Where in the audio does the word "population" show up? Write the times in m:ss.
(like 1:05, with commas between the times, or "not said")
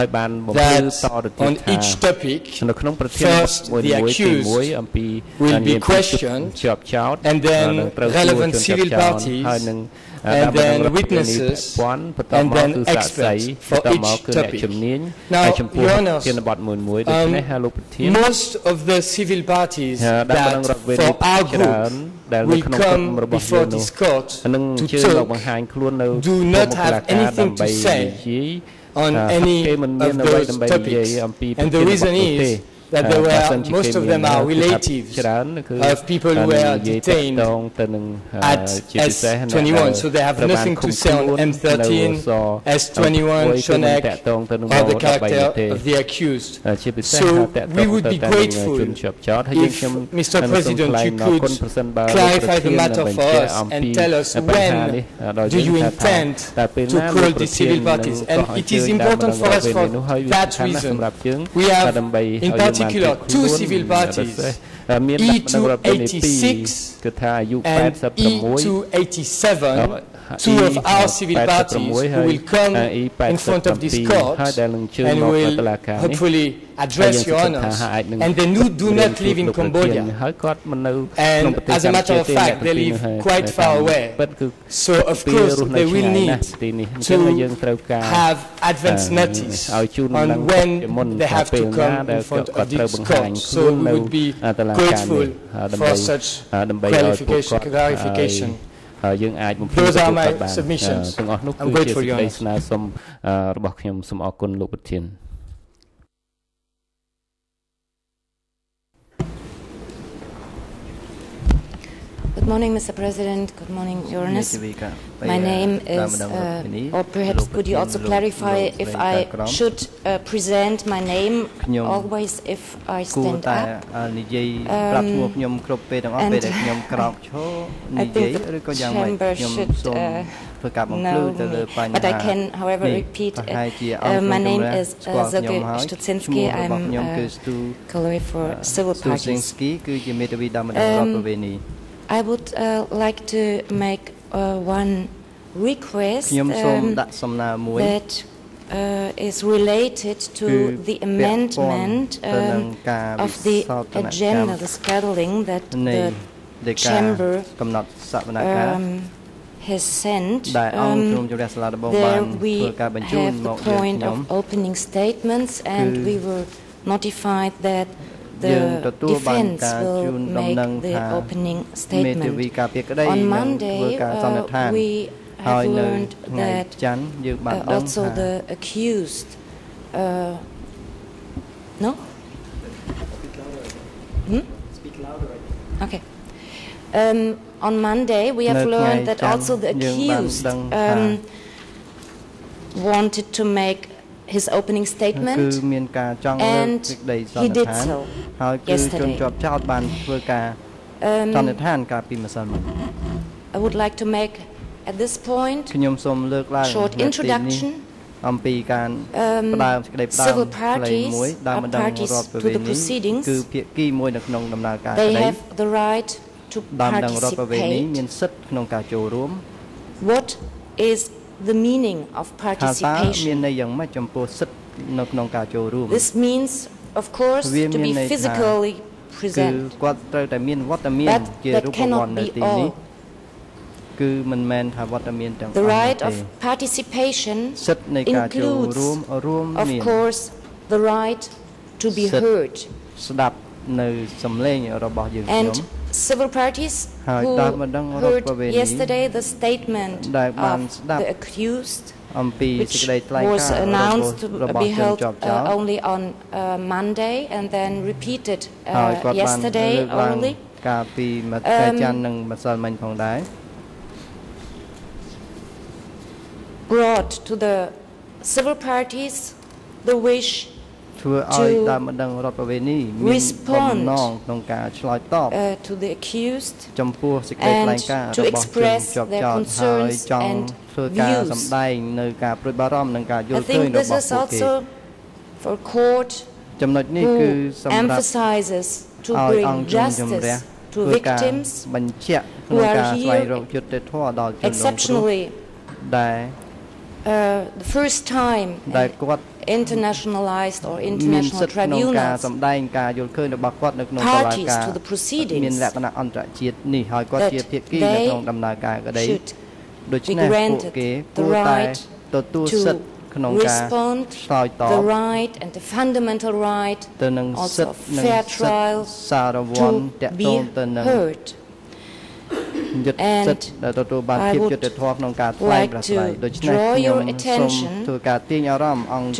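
not said.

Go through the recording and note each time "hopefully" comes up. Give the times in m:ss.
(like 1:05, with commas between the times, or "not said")
1:15.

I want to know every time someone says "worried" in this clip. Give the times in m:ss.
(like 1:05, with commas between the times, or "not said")
not said.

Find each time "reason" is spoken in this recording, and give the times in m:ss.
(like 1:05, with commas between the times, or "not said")
0:31, 1:00.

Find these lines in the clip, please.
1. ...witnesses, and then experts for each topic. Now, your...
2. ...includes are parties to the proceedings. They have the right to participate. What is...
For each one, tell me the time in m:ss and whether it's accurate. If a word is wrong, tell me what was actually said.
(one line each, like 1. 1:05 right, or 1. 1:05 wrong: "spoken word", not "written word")
1. 0:10 right
2. 3:30 wrong: "parties", not "includes".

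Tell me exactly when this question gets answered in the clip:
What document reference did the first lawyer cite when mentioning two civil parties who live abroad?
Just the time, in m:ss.
1:05.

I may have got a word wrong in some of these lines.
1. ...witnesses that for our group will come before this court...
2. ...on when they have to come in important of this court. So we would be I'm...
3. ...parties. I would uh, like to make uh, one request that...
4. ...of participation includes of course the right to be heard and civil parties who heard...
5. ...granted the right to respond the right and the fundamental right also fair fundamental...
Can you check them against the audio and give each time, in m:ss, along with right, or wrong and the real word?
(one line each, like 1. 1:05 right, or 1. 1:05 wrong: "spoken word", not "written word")
1. 0:19 wrong: "parties", not "witnesses"
2. 1:29 wrong: "front", not "important"
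3. 2:18 right
4. 3:56 right
5. 5:10 wrong: "trial", not "fundamental".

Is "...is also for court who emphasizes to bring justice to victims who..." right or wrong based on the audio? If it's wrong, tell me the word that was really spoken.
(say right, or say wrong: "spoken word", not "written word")
right.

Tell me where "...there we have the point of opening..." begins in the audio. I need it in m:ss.
2:41.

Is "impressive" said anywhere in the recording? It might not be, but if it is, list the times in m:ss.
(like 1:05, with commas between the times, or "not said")
not said.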